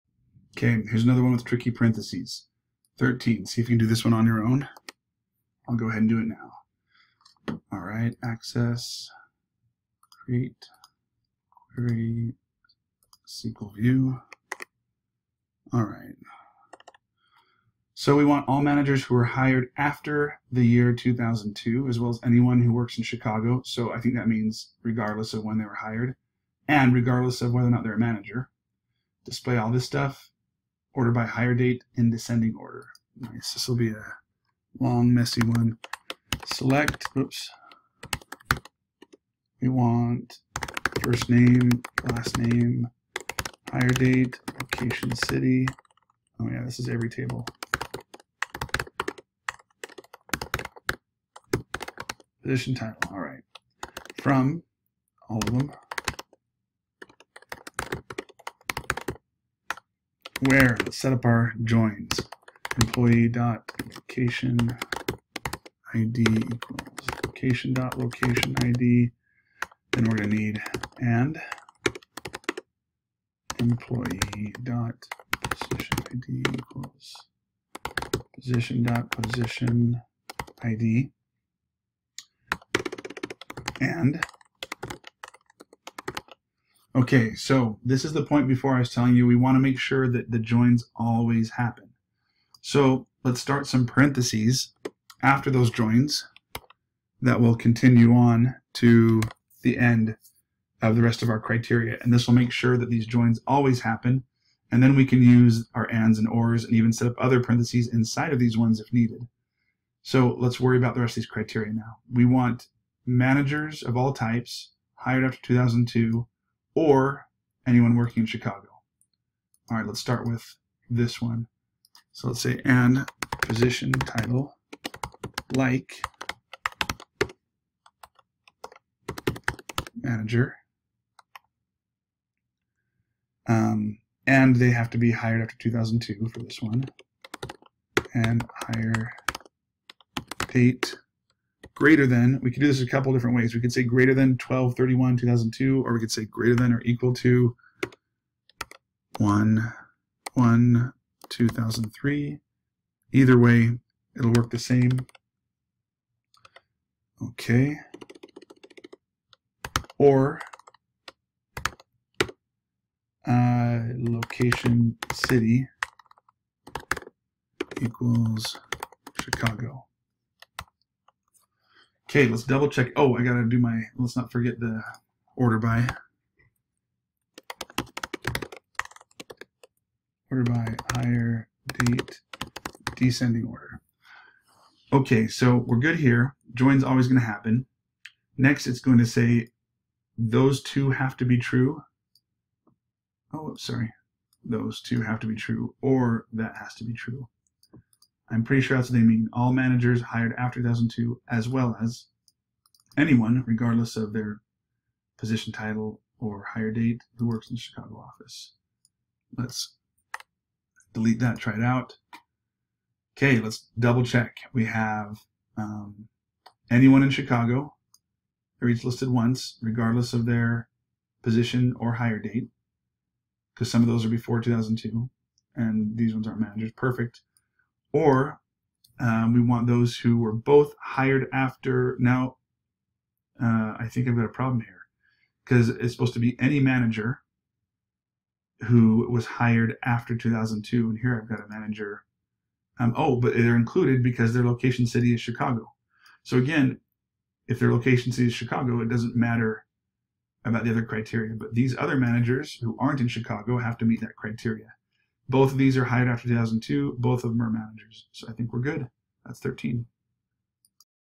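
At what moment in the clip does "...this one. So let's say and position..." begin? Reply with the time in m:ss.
2:00.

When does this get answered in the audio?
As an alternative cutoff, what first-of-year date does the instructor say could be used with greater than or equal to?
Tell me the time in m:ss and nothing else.
2:29.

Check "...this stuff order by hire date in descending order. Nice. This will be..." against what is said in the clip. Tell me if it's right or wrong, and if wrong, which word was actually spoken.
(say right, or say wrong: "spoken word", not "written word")
right.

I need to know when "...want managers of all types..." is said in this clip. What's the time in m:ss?
1:52.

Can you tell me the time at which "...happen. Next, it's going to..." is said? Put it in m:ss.
3:07.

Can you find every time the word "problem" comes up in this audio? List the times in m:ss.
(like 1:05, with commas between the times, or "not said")
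3:54.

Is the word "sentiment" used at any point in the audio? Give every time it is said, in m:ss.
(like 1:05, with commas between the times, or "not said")
not said.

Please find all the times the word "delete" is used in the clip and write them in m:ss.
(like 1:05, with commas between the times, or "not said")
3:30.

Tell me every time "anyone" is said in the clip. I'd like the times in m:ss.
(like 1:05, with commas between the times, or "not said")
0:22, 1:57, 3:22, 3:36.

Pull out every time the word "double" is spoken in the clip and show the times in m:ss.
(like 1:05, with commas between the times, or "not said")
2:52, 3:33.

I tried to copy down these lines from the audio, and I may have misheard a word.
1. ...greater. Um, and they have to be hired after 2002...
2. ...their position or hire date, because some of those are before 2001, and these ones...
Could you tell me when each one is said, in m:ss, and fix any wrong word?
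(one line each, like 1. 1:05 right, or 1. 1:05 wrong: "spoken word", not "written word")
1. 2:09 wrong: "manager", not "greater"
2. 3:40 wrong: "2002", not "2001".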